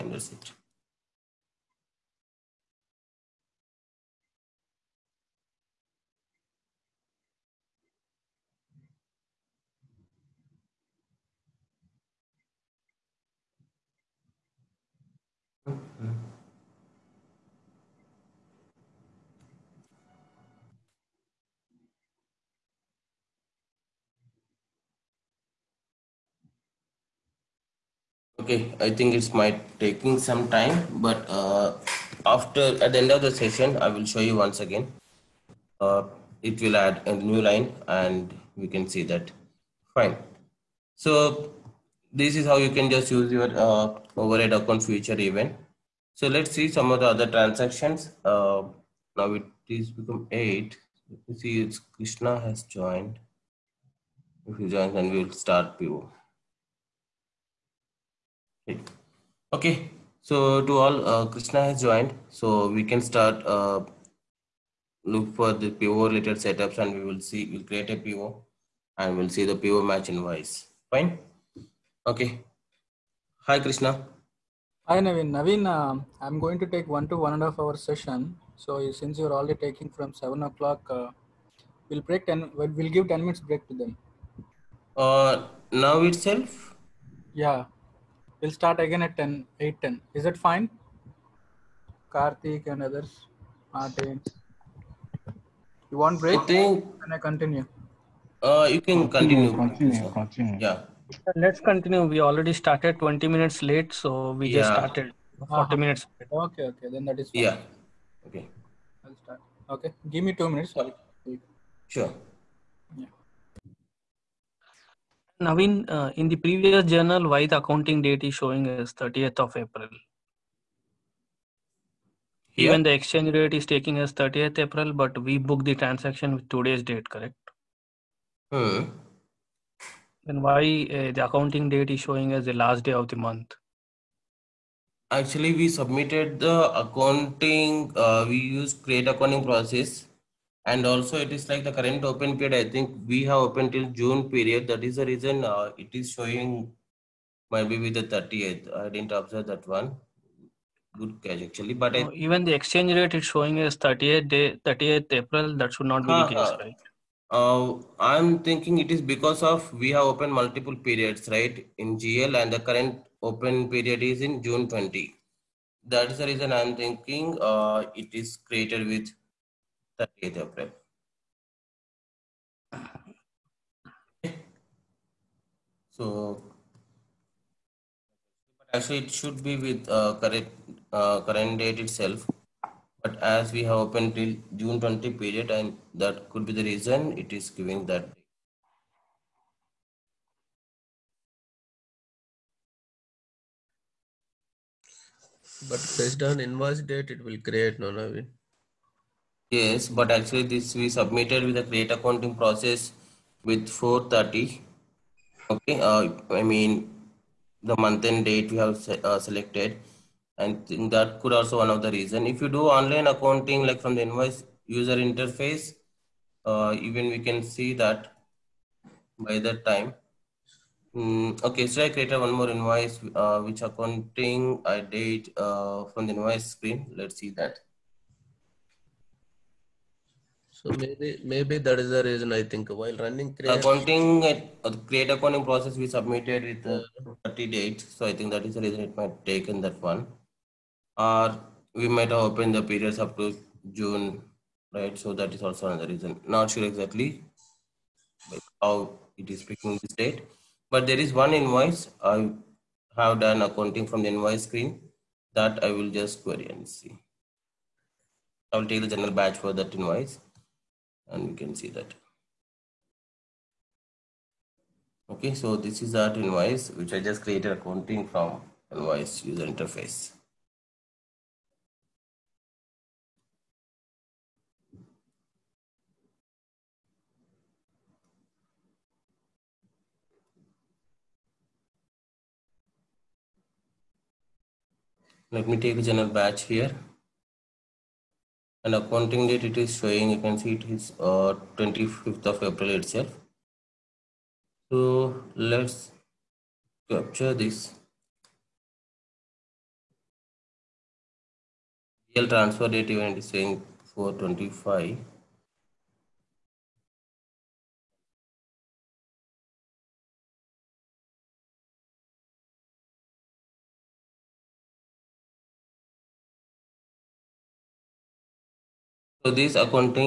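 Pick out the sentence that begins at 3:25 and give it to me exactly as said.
Okay, uh, I mean the month and date we have se uh, selected and that could also one of the reason.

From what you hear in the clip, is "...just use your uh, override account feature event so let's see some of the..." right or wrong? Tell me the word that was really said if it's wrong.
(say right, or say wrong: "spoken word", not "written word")
right.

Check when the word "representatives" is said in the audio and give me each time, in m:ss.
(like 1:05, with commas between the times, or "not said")
not said.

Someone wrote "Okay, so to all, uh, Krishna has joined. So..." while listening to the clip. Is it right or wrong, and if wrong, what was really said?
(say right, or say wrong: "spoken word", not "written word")
right.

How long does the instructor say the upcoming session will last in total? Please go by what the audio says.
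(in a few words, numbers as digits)
1 to 1.5 hours.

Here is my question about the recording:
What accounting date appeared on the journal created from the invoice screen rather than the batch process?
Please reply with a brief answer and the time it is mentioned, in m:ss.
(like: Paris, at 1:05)
25th of April, at 4:51.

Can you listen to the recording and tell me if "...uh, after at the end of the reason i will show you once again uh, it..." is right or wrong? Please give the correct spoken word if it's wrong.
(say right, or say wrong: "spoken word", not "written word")
wrong: "session", not "reason".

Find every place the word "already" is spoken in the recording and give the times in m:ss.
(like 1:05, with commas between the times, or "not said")
1:19, 1:42.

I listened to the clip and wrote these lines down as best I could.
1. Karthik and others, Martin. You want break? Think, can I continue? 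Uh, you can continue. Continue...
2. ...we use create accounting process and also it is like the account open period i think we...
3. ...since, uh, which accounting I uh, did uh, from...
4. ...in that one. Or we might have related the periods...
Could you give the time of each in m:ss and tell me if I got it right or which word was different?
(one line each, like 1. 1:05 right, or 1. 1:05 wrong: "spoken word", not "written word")
1. 1:32 right
2. 2:18 wrong: "current", not "account"
3. 3:42 wrong: "invoice", not "since"
4. 3:59 wrong: "opened", not "related".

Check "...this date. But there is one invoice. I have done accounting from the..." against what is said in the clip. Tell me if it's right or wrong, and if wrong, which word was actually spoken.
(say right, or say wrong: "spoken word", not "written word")
right.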